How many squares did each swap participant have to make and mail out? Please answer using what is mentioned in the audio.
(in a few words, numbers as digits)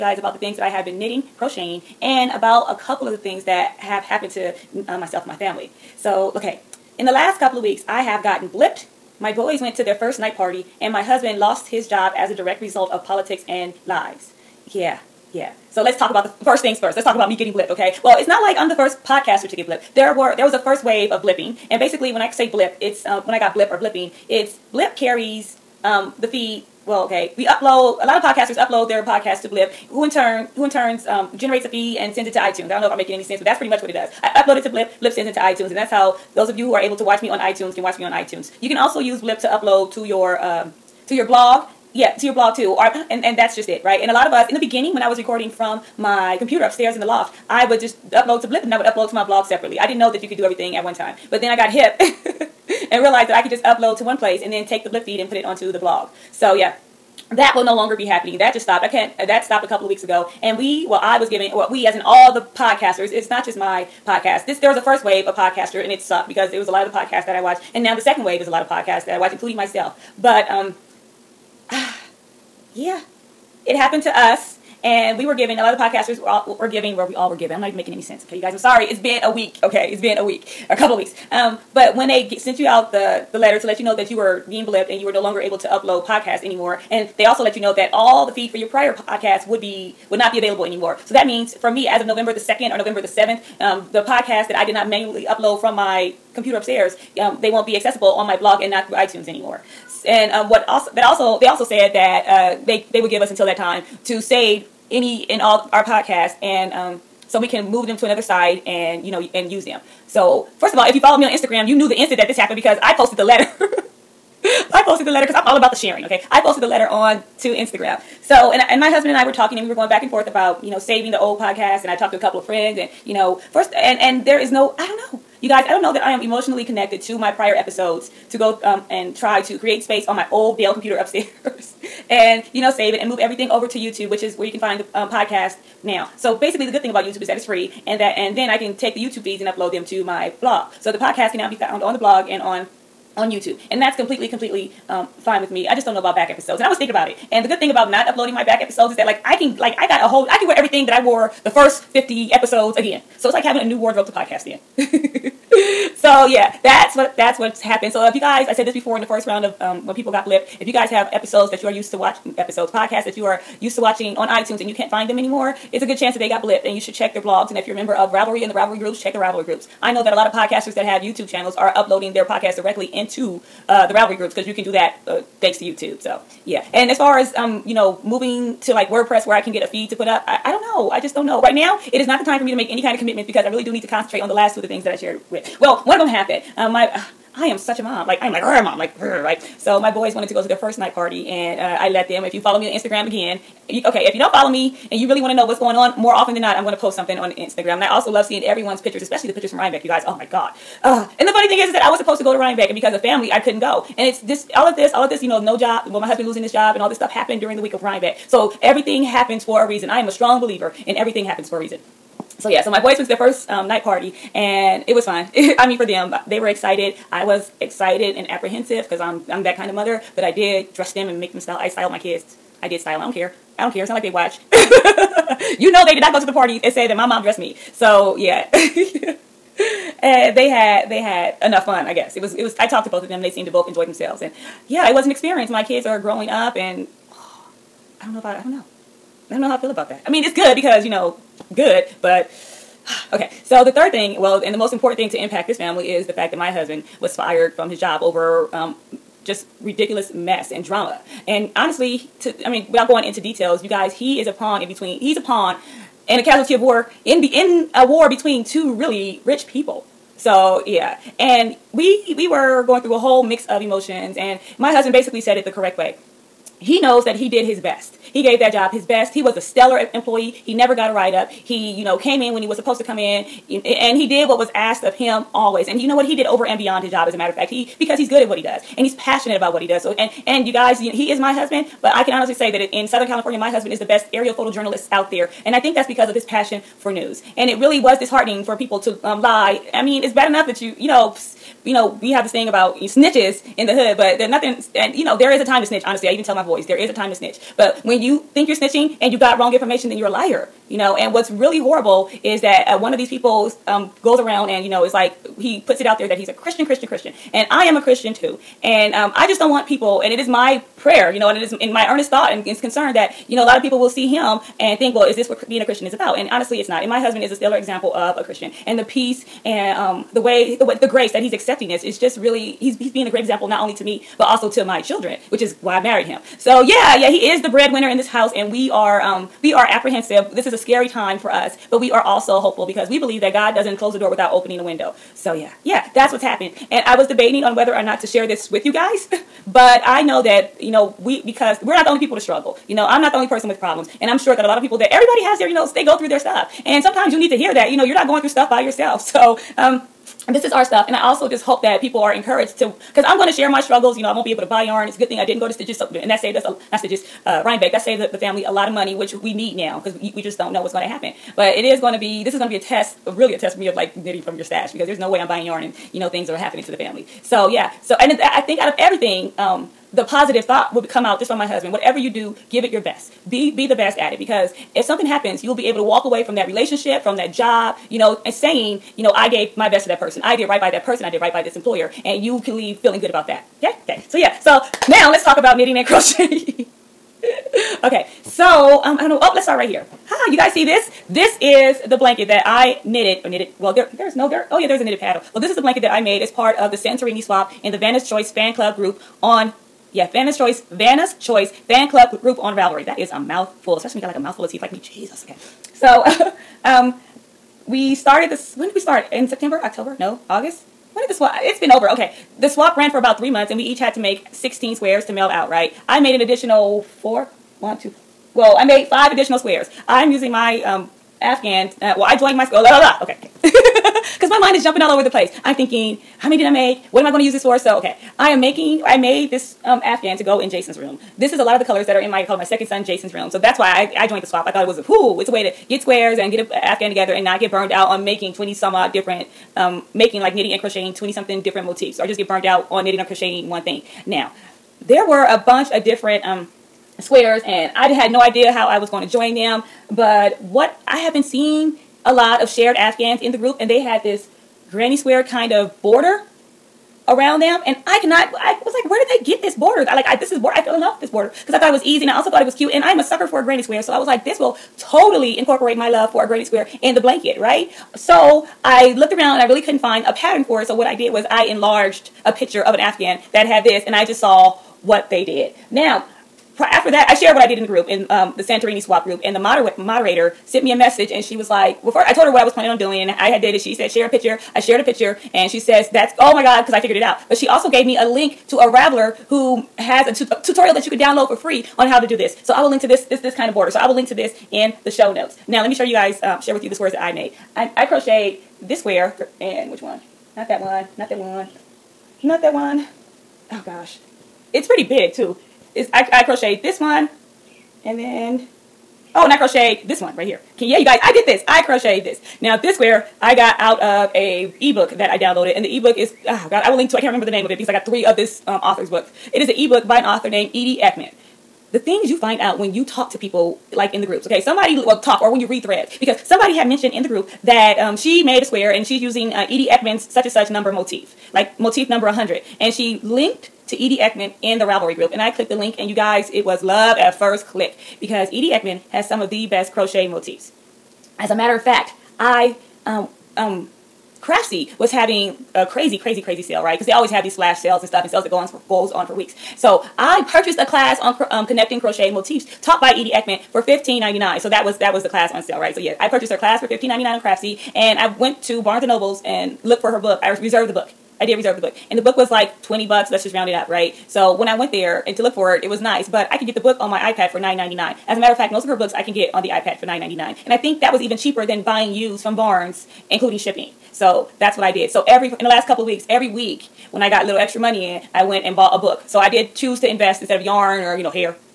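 16.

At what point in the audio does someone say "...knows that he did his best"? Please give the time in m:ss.
4:26.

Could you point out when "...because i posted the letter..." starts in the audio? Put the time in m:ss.
1:52.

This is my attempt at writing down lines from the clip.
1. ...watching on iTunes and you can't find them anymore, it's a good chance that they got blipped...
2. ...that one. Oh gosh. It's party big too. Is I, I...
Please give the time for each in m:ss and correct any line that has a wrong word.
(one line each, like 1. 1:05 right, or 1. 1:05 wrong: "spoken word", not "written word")
1. 2:43 right
2. 8:22 wrong: "pretty", not "party".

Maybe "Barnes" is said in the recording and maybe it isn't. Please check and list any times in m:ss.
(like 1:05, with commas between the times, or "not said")
9:18, 9:32.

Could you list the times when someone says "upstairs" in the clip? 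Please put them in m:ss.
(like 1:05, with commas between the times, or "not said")
0:46, 1:36, 2:10.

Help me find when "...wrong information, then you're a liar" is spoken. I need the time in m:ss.
4:59.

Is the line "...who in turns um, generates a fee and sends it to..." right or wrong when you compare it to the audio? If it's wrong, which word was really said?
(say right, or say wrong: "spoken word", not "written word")
right.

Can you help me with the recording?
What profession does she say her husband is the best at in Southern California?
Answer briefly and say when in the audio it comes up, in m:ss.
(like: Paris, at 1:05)
Aerial photojournalist, at 4:44.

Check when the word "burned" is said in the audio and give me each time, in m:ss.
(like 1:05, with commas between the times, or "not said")
7:17, 7:22.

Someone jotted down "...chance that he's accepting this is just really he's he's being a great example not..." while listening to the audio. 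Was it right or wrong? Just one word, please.
wrong.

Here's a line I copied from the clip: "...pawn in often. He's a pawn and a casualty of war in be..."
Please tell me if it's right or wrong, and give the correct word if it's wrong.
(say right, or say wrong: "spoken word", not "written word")
wrong: "between", not "often".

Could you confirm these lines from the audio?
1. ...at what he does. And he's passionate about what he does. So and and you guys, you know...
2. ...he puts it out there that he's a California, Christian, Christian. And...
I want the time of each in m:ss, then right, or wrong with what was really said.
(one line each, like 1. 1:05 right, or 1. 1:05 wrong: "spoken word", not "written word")
1. 4:38 right
2. 5:05 wrong: "Christian", not "California".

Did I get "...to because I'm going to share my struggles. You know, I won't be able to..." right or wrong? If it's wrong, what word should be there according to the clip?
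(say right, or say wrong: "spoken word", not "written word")
right.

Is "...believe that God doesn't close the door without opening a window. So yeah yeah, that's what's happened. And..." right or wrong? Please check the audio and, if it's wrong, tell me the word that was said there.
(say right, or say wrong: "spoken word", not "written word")
right.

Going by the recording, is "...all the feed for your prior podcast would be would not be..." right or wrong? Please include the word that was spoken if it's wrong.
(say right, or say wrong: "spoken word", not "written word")
right.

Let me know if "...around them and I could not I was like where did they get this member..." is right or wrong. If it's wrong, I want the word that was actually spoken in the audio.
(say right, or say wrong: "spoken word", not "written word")
wrong: "border", not "member".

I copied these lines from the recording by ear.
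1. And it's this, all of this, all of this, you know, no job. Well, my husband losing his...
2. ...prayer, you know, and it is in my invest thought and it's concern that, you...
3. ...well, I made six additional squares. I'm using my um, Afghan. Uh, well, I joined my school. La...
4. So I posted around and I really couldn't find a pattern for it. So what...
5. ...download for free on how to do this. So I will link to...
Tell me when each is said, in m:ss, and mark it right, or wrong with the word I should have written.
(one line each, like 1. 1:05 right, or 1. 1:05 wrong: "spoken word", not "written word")
1. 3:23 right
2. 5:10 wrong: "earnest", not "invest"
3. 6:58 wrong: "five", not "six"
4. 7:47 wrong: "looked", not "posted"
5. 8:10 right.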